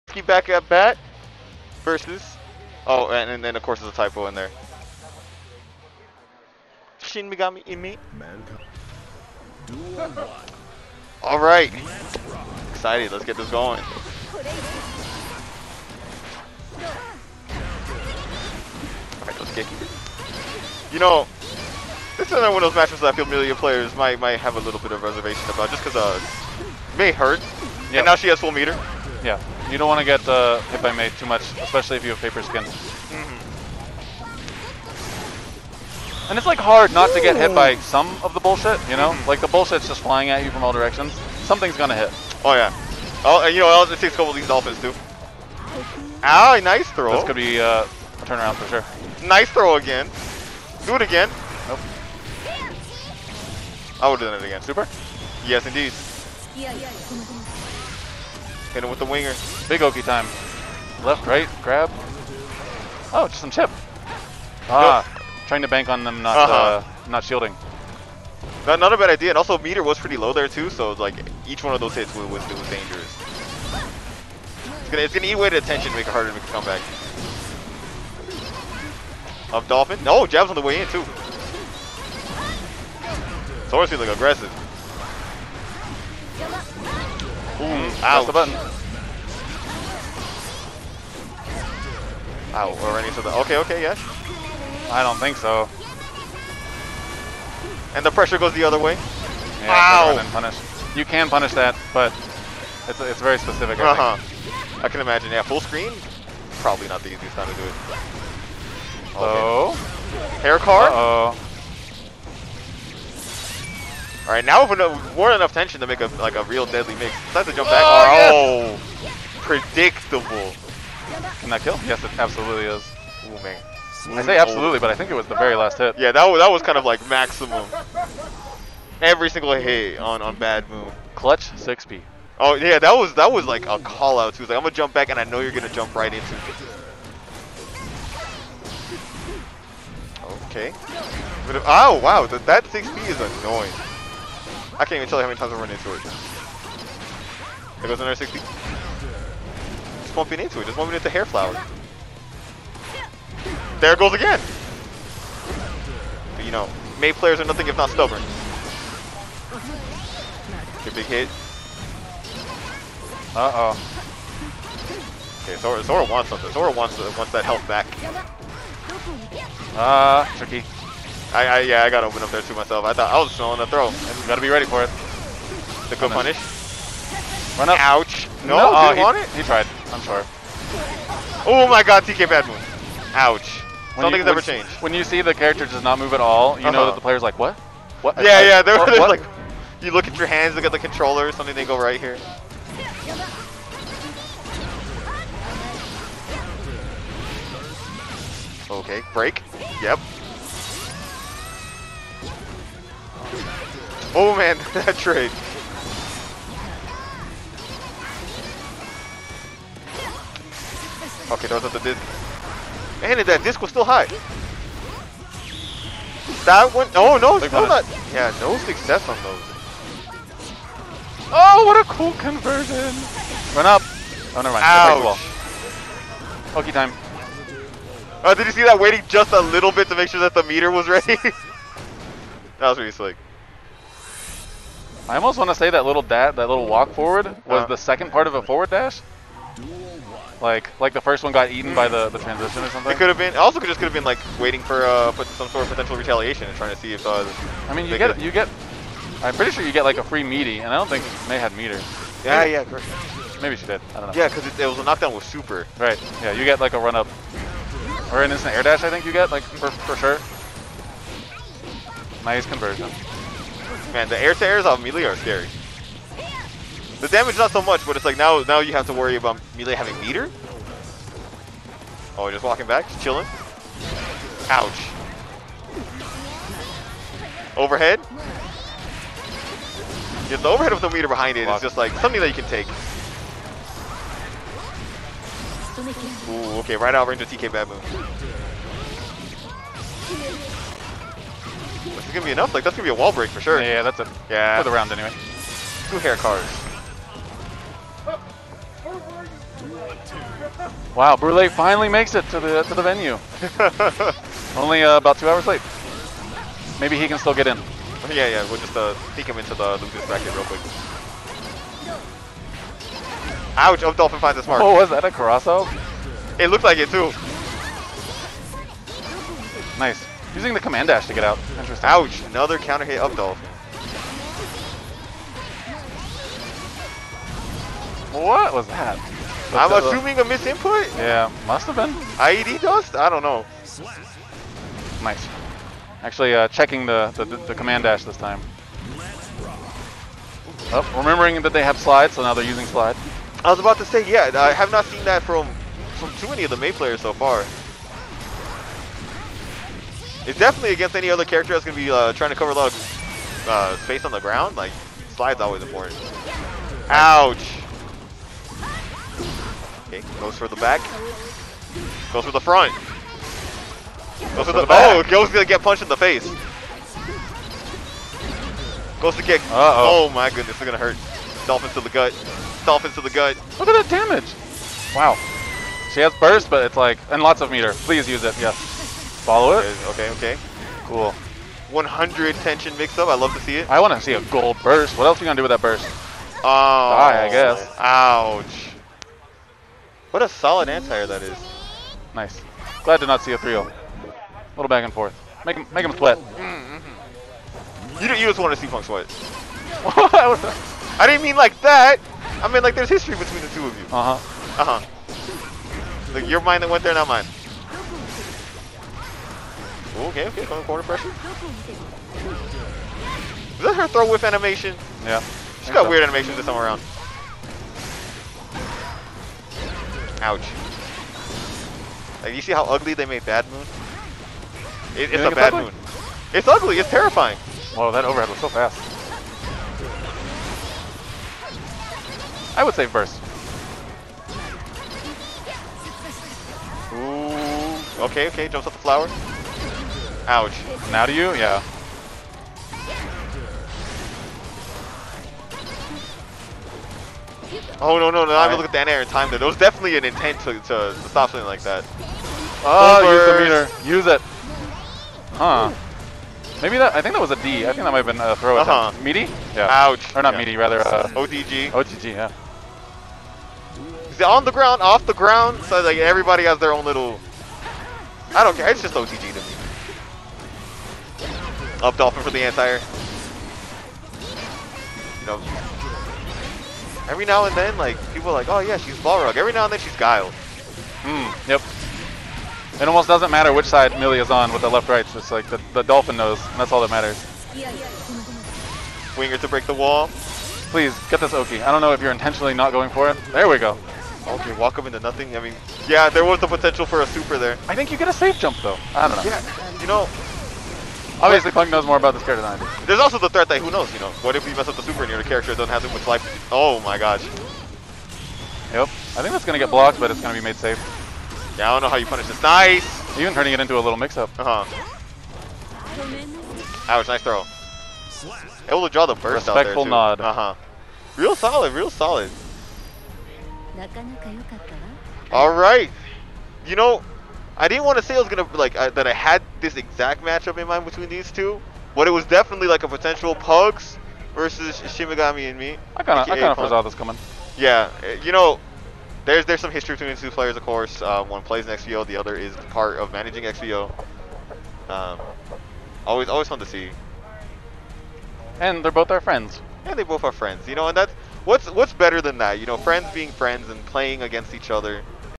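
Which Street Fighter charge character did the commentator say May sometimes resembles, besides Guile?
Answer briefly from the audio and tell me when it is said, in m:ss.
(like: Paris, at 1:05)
Balrog, at 7:58.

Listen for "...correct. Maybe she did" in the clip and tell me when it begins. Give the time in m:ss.
4:12.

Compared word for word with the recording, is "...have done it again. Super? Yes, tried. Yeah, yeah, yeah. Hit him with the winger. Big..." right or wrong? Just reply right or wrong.
wrong.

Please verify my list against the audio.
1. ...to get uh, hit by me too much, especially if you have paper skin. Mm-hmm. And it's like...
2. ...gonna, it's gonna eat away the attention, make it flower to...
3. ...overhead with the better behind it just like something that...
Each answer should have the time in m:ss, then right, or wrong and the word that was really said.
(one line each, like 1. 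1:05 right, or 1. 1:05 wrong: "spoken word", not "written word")
1. 0:30 right
2. 1:14 wrong: "harder", not "flower"
3. 4:40 wrong: "meter", not "better".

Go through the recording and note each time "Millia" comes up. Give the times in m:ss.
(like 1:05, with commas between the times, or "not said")
0:23, 4:24, 4:29, 8:03.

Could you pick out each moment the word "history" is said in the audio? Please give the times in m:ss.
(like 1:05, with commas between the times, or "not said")
6:42, 8:59.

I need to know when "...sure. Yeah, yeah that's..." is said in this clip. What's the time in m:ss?
4:53.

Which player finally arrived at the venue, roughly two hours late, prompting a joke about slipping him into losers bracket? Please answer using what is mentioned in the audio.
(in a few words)
Brule.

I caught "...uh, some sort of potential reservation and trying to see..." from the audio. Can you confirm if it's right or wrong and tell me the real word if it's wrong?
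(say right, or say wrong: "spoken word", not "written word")
wrong: "retaliation", not "reservation".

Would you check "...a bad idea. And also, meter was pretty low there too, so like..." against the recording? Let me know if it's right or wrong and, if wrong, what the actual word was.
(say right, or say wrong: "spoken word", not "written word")
right.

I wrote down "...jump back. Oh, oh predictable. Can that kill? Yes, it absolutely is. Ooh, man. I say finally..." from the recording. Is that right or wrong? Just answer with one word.
wrong.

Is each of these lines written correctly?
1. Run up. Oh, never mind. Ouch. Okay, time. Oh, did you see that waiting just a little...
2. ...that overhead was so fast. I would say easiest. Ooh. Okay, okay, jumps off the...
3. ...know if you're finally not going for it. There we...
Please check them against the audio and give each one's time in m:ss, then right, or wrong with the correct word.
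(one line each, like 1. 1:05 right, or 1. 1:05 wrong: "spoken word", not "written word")
1. 3:43 right
2. 7:07 wrong: "burst", not "easiest"
3. 8:11 wrong: "intentionally", not "finally".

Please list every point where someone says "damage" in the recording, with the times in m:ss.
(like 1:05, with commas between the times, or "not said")
4:27, 6:13.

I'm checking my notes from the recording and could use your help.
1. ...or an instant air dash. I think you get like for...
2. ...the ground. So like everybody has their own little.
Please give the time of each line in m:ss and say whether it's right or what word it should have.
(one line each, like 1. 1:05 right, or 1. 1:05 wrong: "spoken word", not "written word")
1. 4:18 right
2. 7:45 right.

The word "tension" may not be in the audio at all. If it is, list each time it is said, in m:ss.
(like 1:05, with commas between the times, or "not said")
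1:55, 6:22.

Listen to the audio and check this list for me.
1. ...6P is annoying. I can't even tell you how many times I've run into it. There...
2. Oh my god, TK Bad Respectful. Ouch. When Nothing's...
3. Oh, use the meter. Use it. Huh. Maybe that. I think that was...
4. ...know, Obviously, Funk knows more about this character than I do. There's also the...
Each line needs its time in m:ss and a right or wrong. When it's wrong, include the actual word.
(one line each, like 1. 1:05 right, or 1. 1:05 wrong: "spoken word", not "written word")
1. 2:22 right
2. 3:01 wrong: "Moon", not "Respectful"
3. 7:32 right
4. 8:19 wrong: "Punk", not "Funk".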